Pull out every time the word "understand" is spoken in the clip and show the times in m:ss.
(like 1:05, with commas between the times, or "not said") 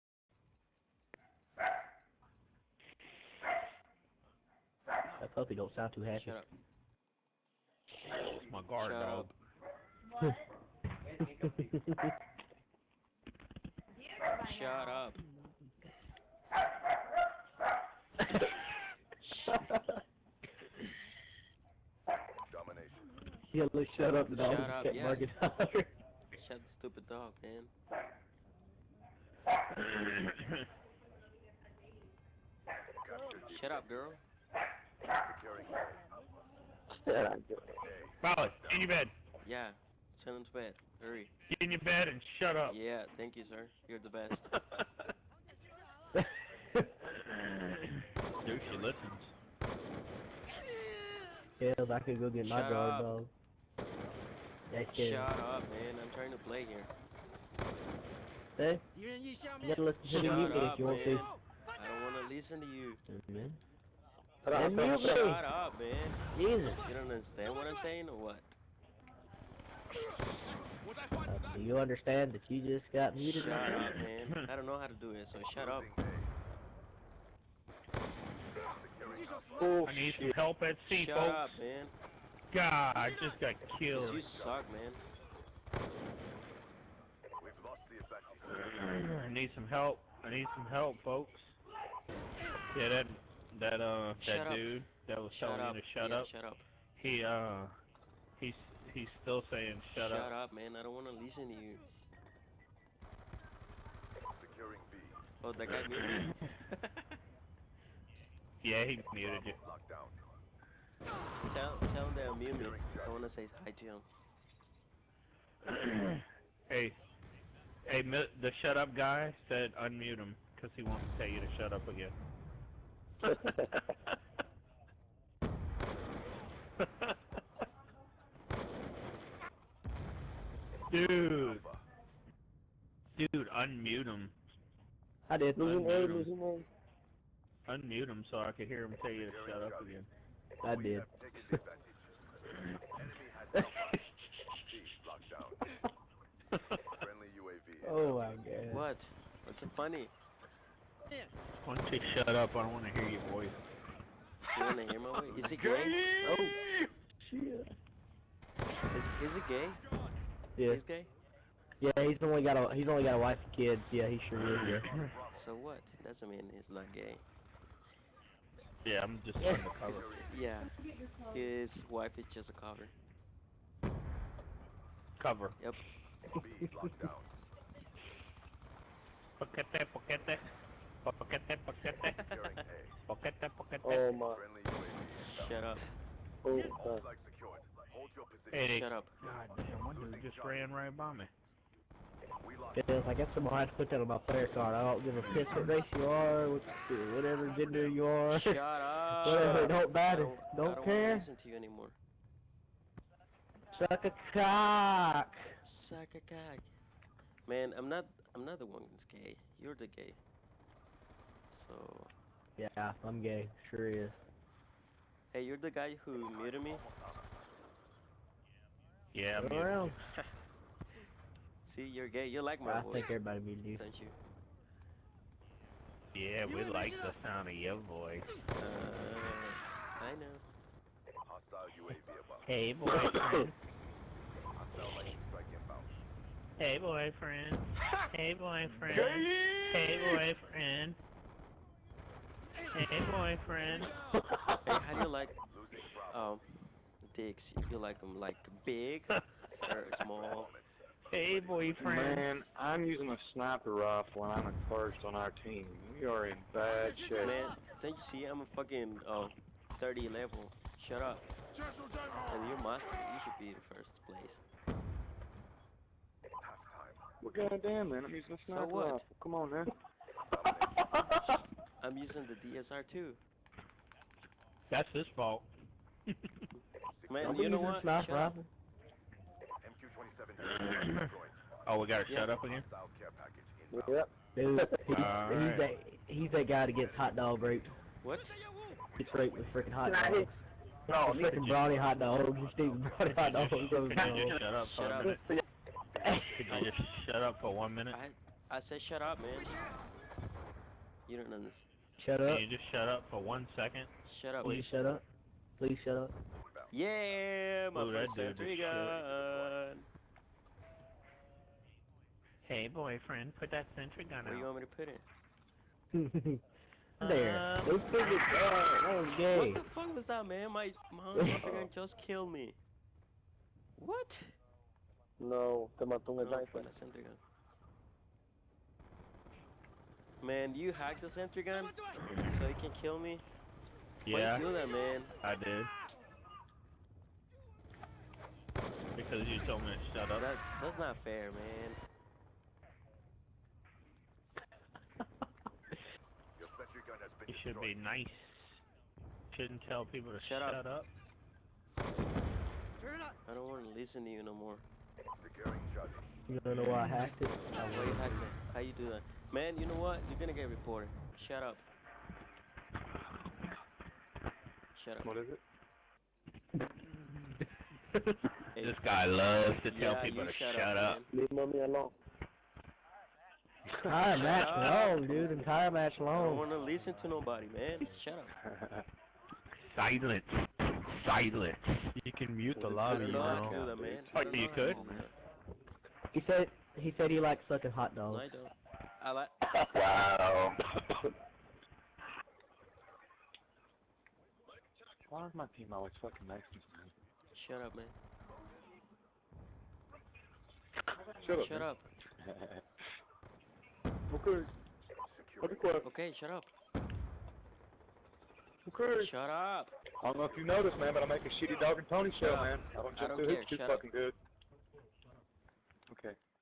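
1:07, 1:11, 5:01.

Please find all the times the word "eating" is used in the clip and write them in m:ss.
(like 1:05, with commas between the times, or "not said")
4:52.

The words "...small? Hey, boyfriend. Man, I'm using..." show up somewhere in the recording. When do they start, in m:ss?
4:10.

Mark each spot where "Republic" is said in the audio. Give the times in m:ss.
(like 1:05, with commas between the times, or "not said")
not said.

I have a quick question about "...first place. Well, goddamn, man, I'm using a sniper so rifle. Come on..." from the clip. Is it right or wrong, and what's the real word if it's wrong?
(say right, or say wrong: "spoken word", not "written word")
right.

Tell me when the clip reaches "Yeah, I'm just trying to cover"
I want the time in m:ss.
2:48.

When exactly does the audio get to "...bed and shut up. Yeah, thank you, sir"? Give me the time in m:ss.
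0:41.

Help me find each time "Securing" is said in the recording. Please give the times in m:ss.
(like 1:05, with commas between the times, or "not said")
1:44.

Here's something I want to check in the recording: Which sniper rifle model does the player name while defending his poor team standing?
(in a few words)
DSR 2.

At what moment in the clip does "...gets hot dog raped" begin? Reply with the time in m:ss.
4:46.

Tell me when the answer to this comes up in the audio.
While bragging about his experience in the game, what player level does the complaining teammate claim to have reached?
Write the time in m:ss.
4:19.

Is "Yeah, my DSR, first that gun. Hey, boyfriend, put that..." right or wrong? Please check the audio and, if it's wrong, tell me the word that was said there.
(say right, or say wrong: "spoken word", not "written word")
wrong: "Ooh", not "DSR".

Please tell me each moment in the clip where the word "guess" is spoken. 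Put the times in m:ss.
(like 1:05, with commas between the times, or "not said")
3:13.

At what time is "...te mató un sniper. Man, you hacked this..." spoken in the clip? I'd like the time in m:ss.
5:25.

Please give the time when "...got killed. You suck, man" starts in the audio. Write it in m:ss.
1:23.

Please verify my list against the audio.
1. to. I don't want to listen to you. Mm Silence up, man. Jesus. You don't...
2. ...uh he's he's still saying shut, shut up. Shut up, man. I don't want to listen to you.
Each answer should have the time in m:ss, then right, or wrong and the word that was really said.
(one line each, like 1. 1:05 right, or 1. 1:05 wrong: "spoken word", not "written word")
1. 1:01 wrong: "Shut", not "Silence"
2. 1:37 right.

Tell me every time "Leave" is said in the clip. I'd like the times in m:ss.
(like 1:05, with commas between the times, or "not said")
6:11.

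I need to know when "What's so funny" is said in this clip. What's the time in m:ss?
2:29.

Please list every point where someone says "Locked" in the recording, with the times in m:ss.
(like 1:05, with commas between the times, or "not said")
2:56.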